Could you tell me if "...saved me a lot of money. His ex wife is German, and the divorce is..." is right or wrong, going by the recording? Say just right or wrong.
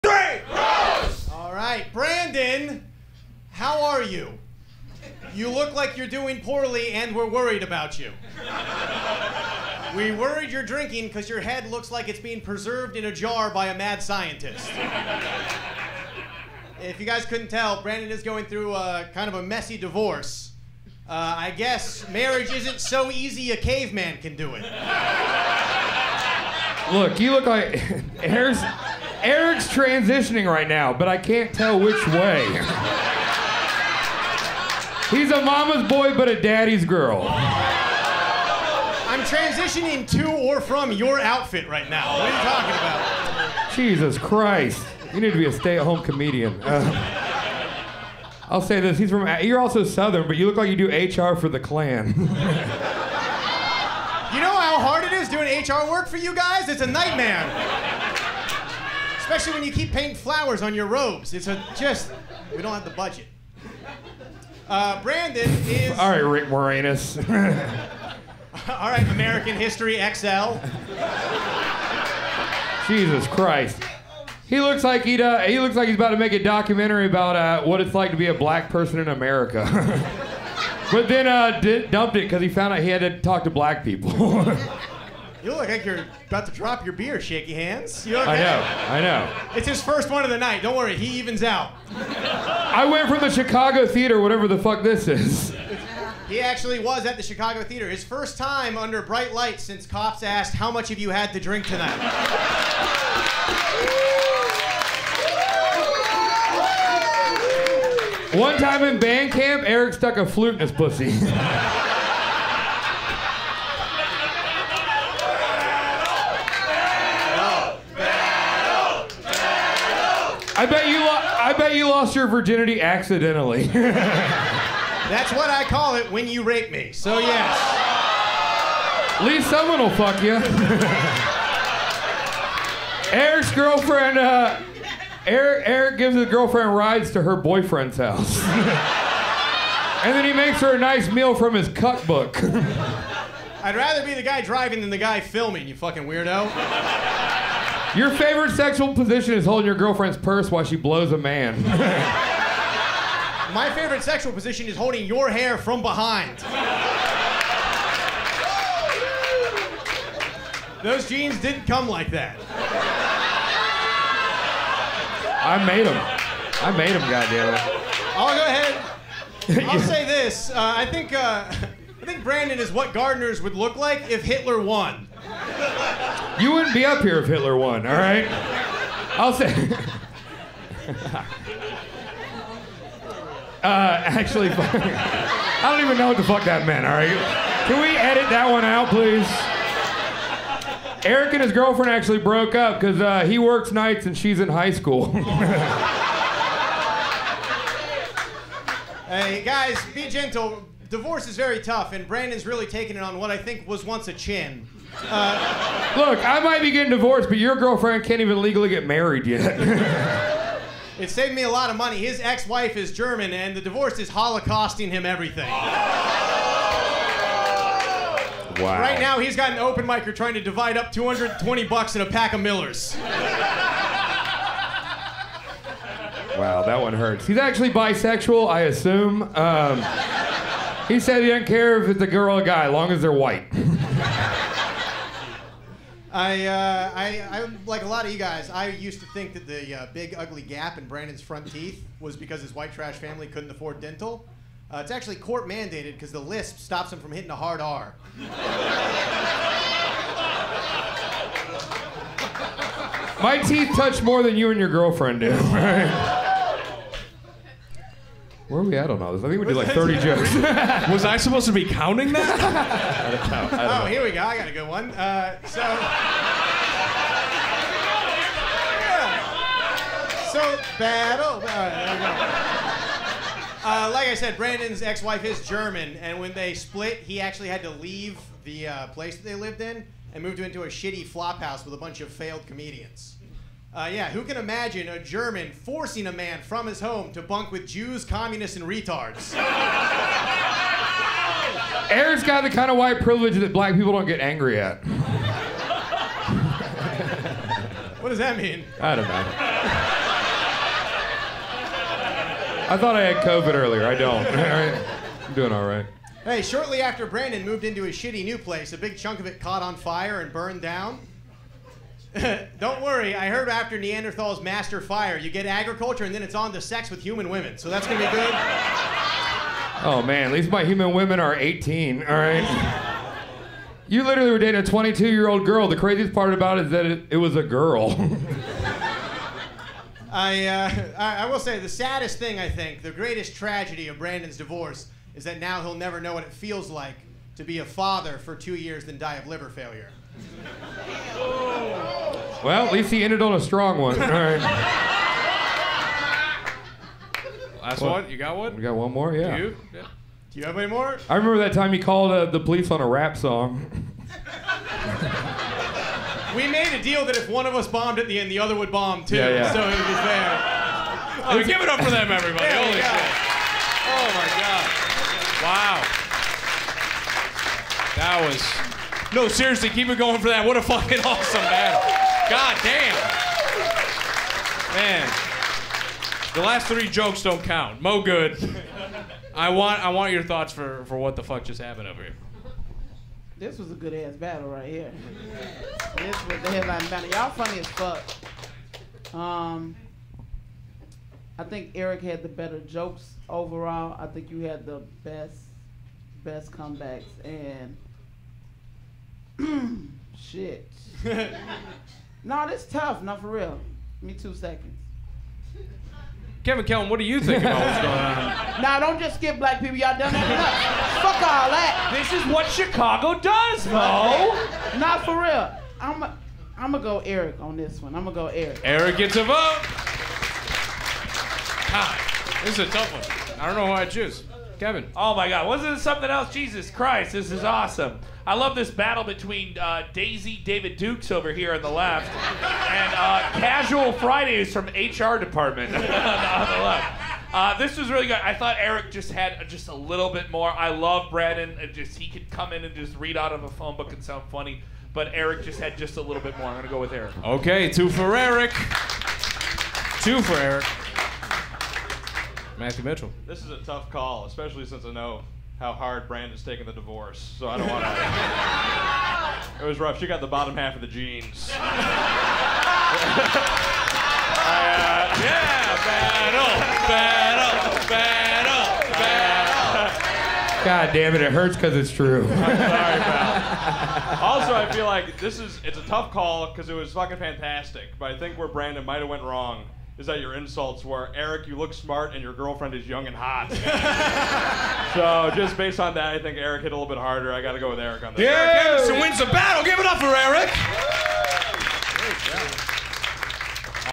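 right.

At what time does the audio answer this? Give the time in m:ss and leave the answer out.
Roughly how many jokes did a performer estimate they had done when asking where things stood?
4:19.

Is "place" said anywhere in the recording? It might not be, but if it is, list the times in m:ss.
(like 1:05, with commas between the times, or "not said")
4:38, 5:08.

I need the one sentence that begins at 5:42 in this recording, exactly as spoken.
Well, at least he ended on a strong one.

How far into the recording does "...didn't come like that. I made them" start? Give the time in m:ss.
2:41.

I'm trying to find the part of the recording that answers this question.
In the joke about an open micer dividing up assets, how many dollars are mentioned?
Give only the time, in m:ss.
3:40.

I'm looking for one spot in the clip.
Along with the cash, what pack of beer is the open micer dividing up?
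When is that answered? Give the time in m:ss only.
3:42.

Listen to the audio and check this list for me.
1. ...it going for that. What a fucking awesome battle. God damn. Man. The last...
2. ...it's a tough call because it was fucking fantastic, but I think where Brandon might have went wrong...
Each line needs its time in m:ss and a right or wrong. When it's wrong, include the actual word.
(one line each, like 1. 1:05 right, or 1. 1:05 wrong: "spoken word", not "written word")
1. 6:09 right
2. 7:55 right.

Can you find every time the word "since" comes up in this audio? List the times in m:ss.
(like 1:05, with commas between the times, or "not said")
1:39, 7:34.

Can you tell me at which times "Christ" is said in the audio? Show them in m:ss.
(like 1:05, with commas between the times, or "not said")
0:44, 1:13, 7:06.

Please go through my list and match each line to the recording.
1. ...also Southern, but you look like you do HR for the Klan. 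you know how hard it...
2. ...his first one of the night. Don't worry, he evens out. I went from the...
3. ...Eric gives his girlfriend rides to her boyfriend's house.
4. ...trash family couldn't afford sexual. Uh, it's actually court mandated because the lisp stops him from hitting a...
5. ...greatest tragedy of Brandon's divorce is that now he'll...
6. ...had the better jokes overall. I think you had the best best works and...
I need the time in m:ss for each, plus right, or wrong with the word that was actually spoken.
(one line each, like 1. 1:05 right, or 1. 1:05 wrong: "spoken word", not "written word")
1. 0:49 right
2. 1:29 right
3. 2:15 right
4. 4:02 wrong: "dental", not "sexual"
5. 5:32 right
6. 6:32 wrong: "comebacks", not "works".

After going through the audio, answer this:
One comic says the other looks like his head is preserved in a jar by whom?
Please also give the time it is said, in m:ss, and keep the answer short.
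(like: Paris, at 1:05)
A mad scientist, at 0:13.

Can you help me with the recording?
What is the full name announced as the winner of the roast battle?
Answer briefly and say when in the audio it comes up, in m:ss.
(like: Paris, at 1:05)
Eric Anderson, at 8:08.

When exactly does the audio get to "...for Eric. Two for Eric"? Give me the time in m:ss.
7:27.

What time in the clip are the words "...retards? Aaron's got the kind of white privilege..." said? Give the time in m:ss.
4:48.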